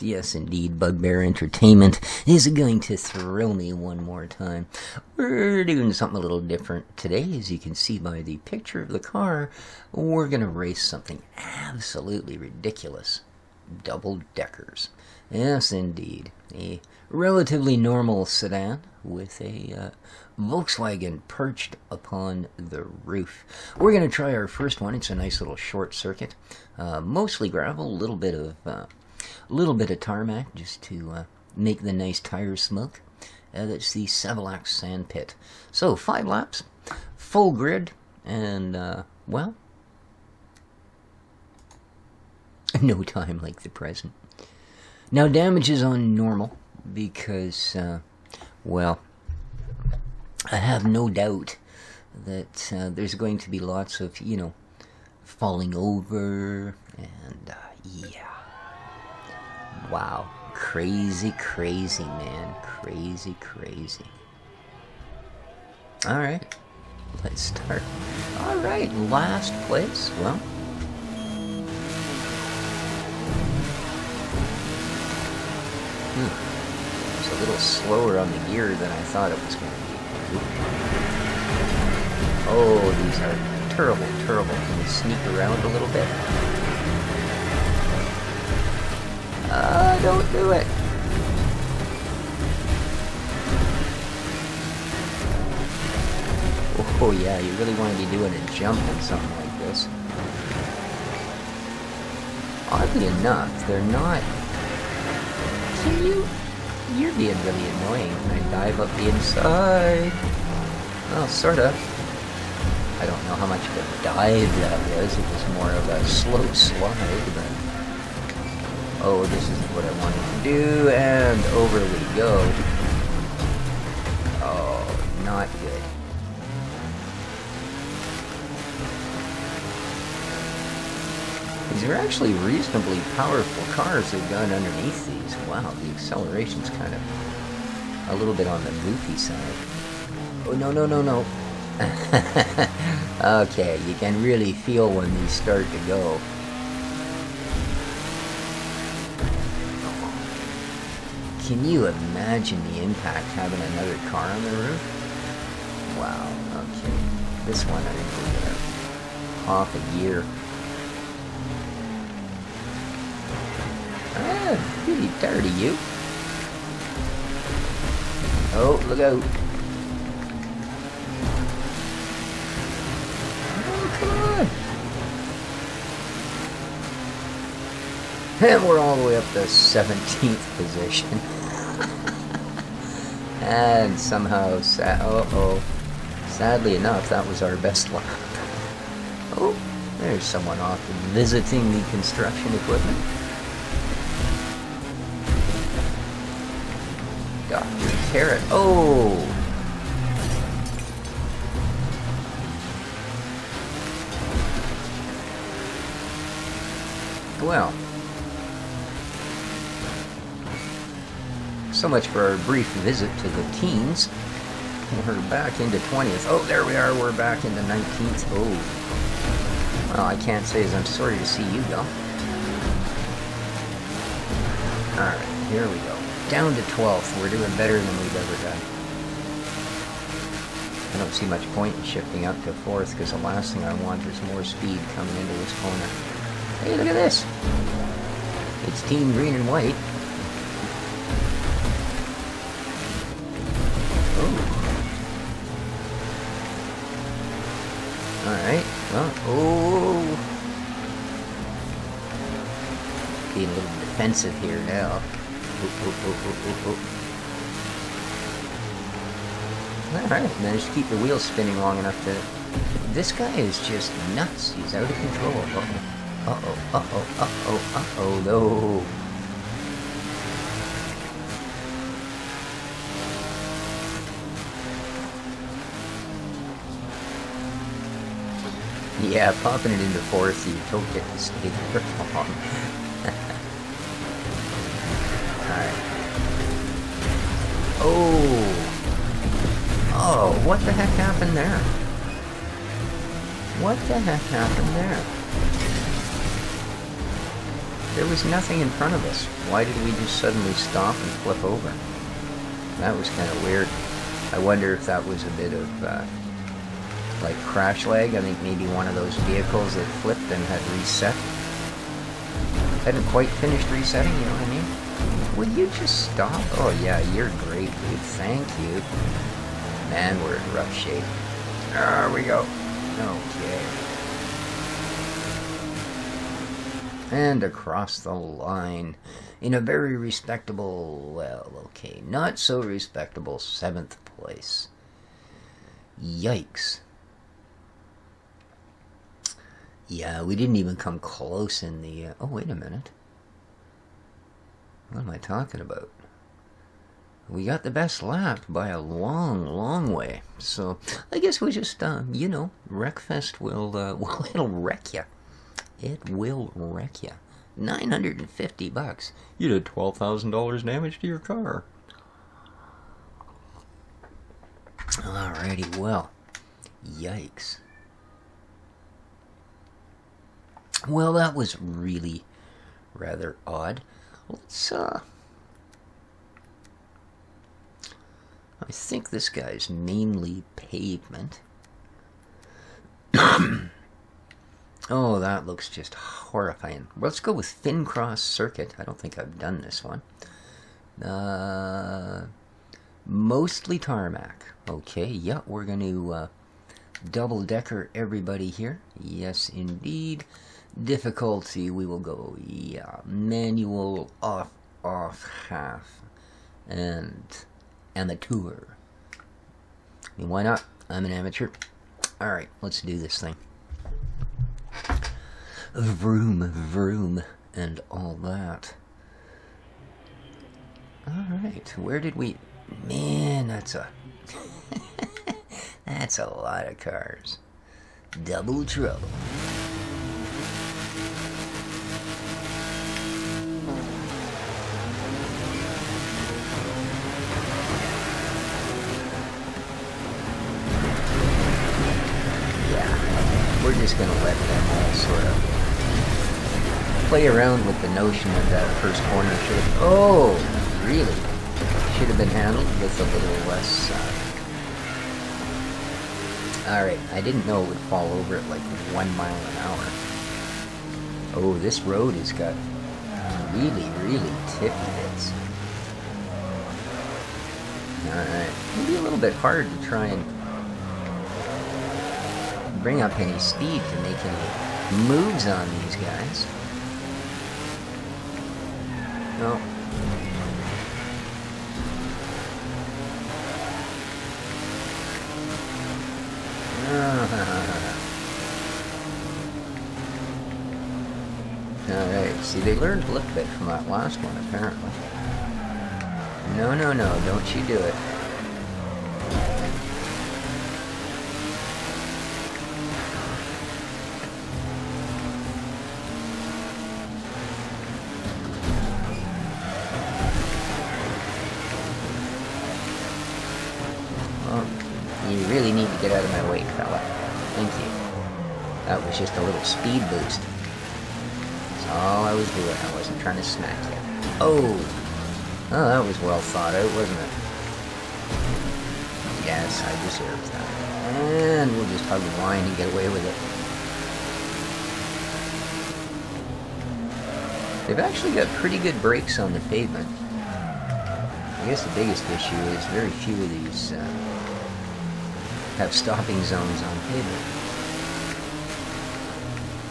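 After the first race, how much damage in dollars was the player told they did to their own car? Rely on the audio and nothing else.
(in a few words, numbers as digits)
$12,000.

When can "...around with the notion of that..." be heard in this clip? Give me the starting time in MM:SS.
07:27.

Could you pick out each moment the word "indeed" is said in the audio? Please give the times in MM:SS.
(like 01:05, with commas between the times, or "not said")
00:00, 00:15, 06:39.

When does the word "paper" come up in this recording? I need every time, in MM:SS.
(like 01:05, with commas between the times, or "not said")
09:07.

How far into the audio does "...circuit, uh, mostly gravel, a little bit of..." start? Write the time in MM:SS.
00:25.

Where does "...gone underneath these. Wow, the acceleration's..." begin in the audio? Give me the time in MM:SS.
02:14.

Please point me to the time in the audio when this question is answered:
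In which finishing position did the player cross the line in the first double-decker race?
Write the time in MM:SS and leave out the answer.
05:33.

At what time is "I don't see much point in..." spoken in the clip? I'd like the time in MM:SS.
03:50.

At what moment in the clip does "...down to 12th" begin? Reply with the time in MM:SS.
03:46.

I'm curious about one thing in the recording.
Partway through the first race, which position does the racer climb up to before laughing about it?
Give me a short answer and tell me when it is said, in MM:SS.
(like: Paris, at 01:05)
17th, at 02:59.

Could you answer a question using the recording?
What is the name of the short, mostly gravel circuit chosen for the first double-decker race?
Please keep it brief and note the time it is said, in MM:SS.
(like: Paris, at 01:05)
Savolax Sand Pit, at 00:34.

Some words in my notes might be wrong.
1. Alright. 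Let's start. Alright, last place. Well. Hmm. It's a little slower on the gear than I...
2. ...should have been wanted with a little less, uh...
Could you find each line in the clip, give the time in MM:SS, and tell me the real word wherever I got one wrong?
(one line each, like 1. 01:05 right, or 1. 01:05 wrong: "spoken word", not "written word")
1. 01:06 right
2. 07:31 wrong: "handled", not "wanted".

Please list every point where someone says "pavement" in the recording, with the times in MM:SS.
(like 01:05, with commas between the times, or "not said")
06:20, 08:59.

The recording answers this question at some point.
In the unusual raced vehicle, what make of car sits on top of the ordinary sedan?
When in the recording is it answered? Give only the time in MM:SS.
00:20.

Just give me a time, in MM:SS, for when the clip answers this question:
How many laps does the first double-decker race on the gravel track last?
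00:35.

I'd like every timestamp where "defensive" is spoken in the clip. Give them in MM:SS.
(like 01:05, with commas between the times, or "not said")
04:13.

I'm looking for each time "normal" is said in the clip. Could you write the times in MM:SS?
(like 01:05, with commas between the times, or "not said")
00:17, 00:46.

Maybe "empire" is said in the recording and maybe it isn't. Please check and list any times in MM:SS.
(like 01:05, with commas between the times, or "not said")
not said.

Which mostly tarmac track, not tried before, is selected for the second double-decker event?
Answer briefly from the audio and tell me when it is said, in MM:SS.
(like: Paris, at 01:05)
Finncross circuit, at 06:27.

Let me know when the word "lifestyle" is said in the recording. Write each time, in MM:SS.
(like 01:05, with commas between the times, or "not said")
not said.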